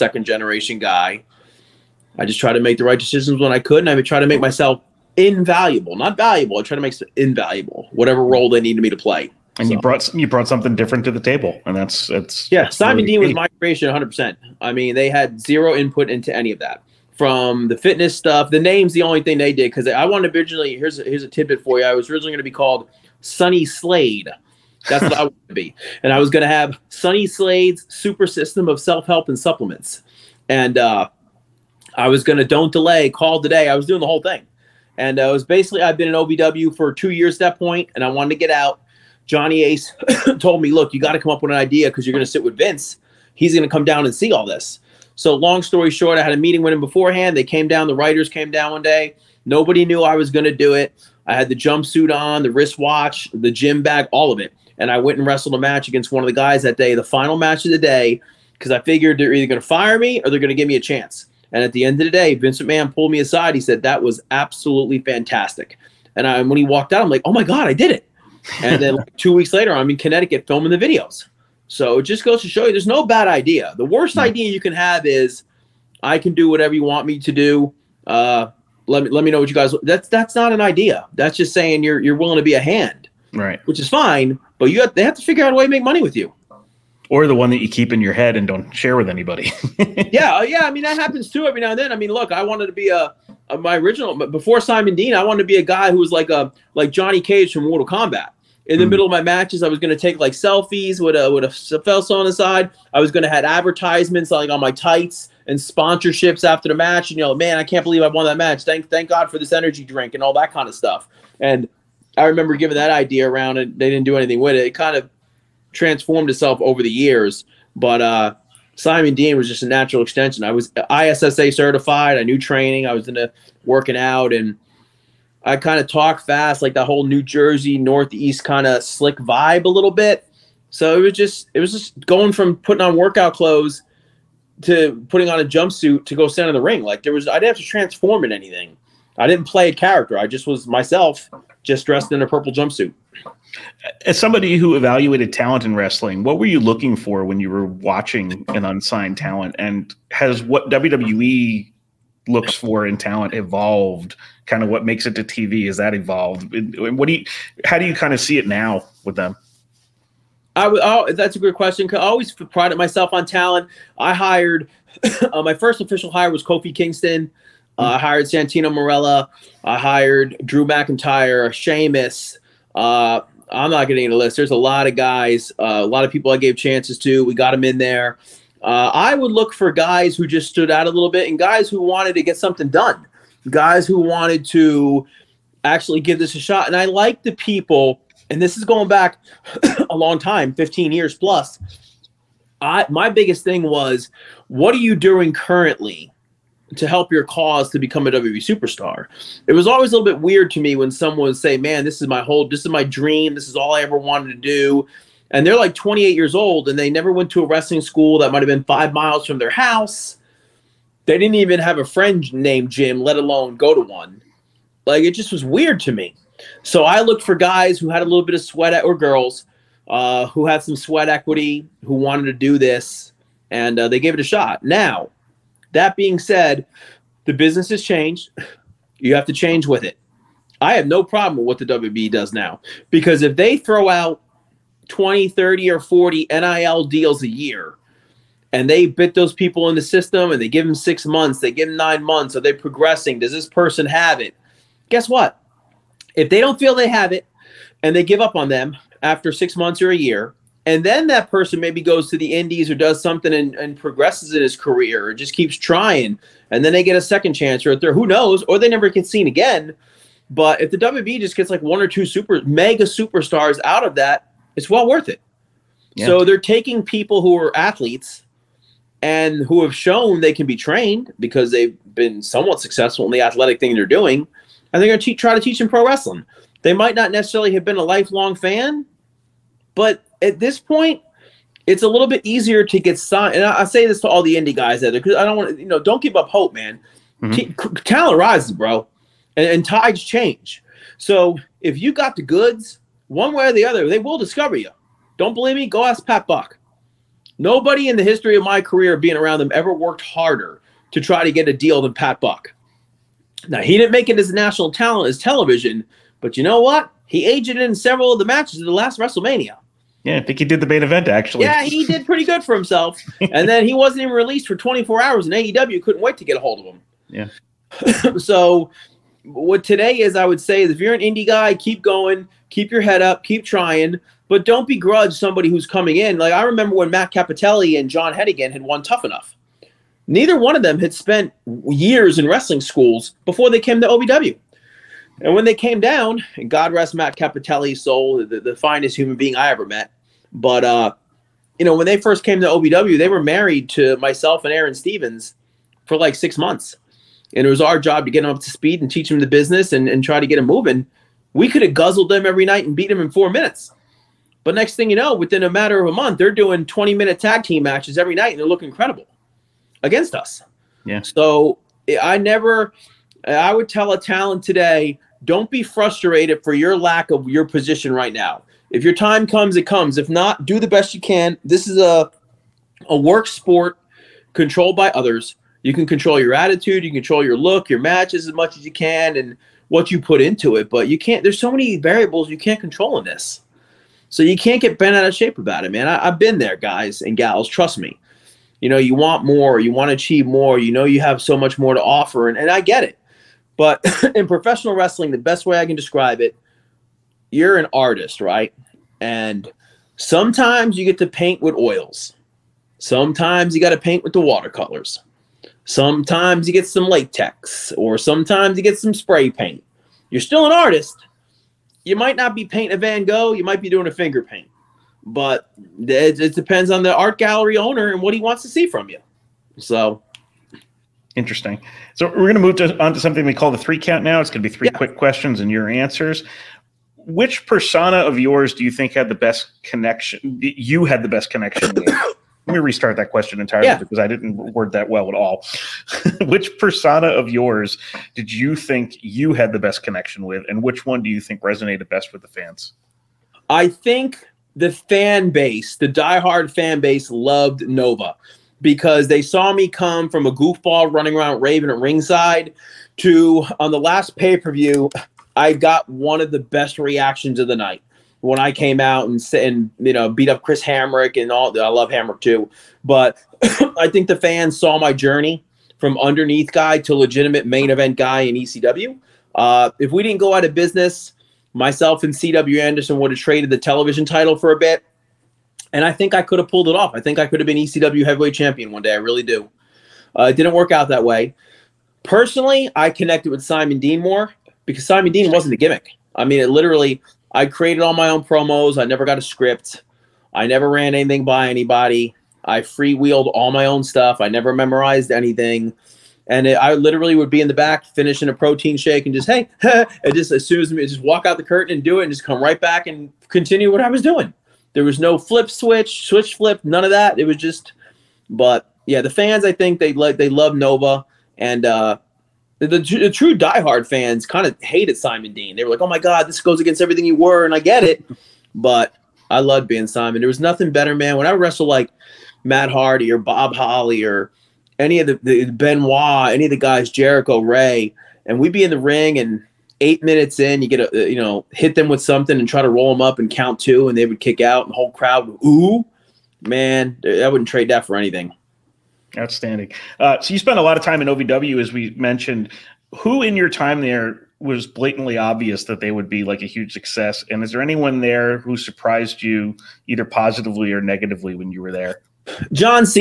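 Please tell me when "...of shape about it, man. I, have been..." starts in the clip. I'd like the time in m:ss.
6:25.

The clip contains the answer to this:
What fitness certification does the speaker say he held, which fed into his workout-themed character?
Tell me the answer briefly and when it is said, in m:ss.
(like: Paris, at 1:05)
ISSA, at 2:00.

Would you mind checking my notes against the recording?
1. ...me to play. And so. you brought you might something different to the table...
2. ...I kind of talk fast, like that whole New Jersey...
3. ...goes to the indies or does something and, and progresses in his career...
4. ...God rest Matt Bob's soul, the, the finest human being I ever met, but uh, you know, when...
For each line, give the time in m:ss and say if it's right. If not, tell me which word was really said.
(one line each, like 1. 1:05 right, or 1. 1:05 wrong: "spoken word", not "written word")
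1. 0:08 wrong: "brought", not "might"
2. 2:05 right
3. 4:11 right
4. 5:36 wrong: "Cappotelli", not "Bob".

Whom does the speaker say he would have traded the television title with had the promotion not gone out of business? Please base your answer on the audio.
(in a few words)
CW Anderson.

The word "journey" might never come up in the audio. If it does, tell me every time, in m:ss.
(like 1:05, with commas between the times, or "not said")
7:44.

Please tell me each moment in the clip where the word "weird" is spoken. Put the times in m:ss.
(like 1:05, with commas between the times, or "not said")
3:20, 3:35.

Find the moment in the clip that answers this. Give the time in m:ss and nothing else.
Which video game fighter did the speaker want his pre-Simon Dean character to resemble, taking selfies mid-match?
1:36.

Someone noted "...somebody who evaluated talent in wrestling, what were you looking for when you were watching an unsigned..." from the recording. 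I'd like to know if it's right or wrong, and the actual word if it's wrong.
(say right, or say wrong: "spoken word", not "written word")
right.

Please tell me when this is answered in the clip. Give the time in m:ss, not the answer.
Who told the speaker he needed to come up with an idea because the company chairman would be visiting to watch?
0:39.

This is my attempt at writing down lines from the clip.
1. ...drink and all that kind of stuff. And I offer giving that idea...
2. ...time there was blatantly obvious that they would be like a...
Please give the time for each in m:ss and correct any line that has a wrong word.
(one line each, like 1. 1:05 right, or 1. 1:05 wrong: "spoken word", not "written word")
1. 1:49 wrong: "remember", not "offer"
2. 9:03 right.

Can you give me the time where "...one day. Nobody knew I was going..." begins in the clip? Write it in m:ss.
0:48.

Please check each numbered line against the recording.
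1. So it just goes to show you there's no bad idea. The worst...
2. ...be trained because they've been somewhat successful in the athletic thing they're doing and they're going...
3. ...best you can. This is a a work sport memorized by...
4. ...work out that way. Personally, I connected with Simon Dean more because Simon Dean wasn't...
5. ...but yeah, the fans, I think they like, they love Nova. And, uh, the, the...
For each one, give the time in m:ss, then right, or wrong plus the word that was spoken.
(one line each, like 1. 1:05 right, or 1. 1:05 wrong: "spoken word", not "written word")
1. 1:11 right
2. 4:30 right
3. 6:10 wrong: "controlled", not "memorized"
4. 8:00 right
5. 8:28 right.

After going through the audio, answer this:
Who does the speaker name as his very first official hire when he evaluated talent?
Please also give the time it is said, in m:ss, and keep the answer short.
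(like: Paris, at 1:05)
Kofi Kingston, at 2:46.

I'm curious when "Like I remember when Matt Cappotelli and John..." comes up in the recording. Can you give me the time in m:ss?
5:26.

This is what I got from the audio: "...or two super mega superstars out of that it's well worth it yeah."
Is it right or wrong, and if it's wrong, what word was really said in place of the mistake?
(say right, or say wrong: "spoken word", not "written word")
right.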